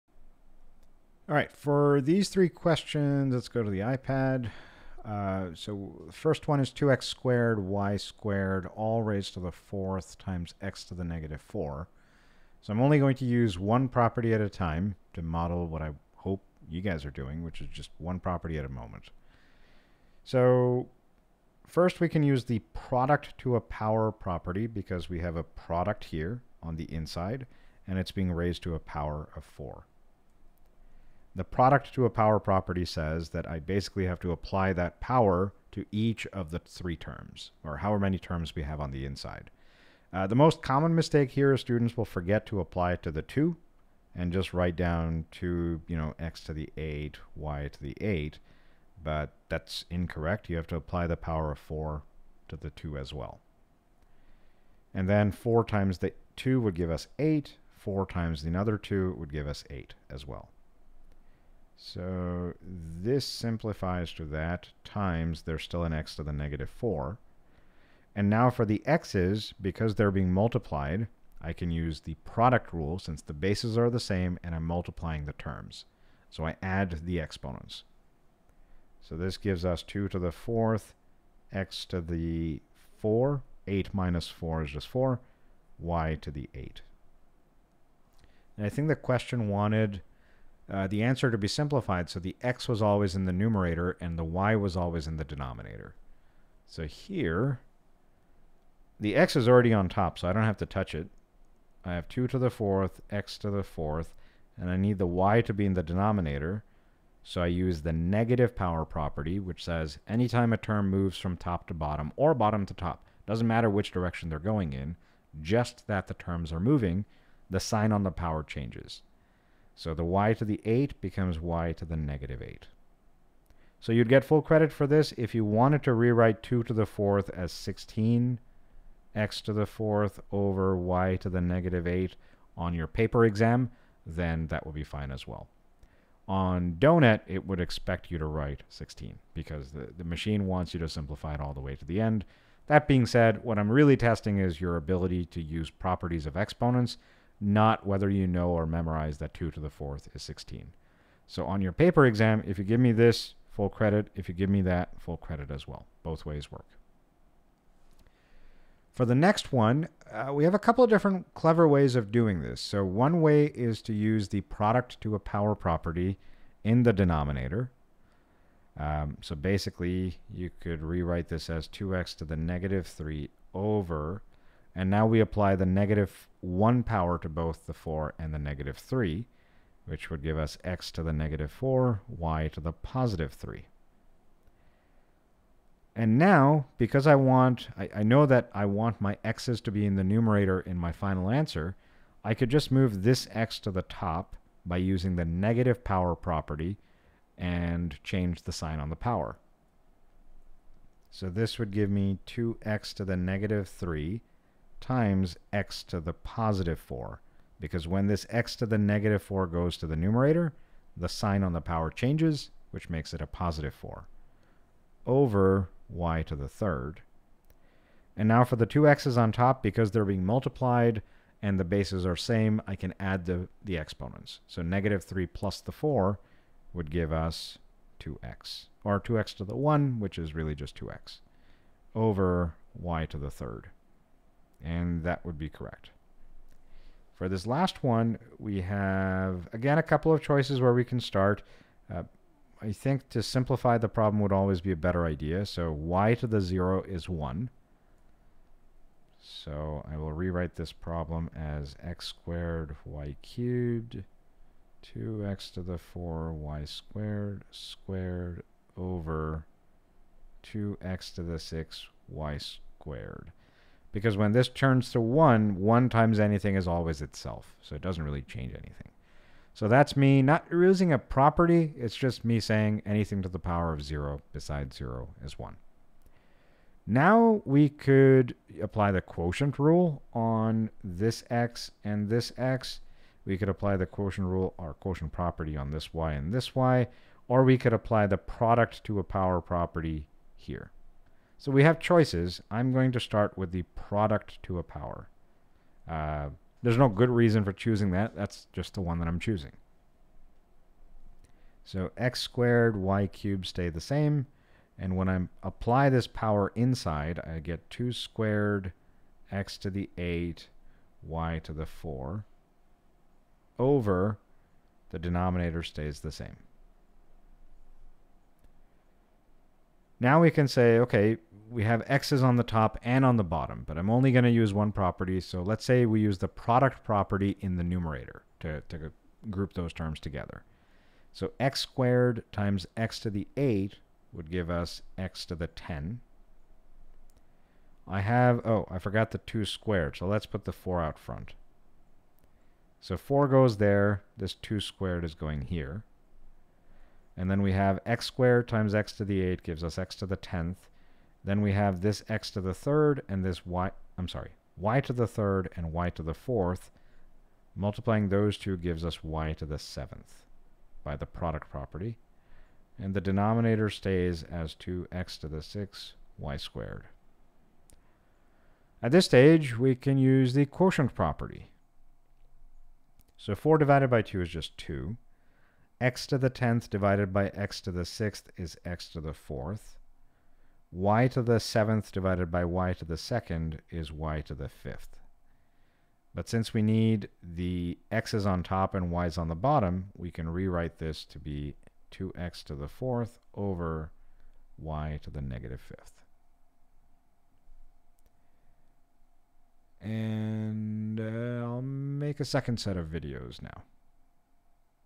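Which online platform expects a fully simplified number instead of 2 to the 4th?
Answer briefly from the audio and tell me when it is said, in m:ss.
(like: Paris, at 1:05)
Donut, at 2:16.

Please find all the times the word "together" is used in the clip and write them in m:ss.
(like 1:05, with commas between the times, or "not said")
5:29.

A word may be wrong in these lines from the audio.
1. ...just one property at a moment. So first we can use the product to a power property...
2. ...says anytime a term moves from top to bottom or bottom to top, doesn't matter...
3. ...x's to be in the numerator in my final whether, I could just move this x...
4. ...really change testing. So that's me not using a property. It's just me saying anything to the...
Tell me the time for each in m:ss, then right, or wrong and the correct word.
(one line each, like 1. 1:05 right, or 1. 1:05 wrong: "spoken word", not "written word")
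1. 0:17 right
2. 1:49 right
3. 3:09 wrong: "answer", not "whether"
4. 4:28 wrong: "anything", not "testing".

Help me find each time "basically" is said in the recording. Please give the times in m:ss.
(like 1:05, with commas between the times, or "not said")
0:33, 2:49.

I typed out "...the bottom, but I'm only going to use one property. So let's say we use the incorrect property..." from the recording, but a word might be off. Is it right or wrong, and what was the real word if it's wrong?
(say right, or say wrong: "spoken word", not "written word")
wrong: "product", not "incorrect".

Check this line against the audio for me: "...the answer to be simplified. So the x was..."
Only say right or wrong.
right.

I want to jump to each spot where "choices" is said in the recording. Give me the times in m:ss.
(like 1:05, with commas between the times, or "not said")
4:00, 4:51.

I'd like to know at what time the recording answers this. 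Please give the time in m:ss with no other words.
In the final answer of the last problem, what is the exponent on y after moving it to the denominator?
6:35.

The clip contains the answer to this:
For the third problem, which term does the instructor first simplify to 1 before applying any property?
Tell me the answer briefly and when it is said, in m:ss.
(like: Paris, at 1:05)
y to the 0, at 4:05.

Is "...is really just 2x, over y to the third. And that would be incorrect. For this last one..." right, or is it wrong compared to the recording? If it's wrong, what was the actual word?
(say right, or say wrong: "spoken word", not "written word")
wrong: "correct", not "incorrect".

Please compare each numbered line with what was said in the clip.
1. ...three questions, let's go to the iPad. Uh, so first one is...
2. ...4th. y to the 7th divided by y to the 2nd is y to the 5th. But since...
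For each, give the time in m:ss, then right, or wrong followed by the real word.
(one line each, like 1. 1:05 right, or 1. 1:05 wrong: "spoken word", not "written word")
1. 0:02 right
2. 6:19 right.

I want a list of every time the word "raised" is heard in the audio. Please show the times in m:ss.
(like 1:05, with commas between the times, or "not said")
0:09, 0:28.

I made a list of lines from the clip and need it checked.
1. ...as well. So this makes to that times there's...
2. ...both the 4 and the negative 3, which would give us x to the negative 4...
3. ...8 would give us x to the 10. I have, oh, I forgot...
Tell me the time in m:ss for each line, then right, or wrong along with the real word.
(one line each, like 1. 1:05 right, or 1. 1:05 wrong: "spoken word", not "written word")
1. 1:00 wrong: "simplifies", not "makes"
2. 2:57 right
3. 5:33 right.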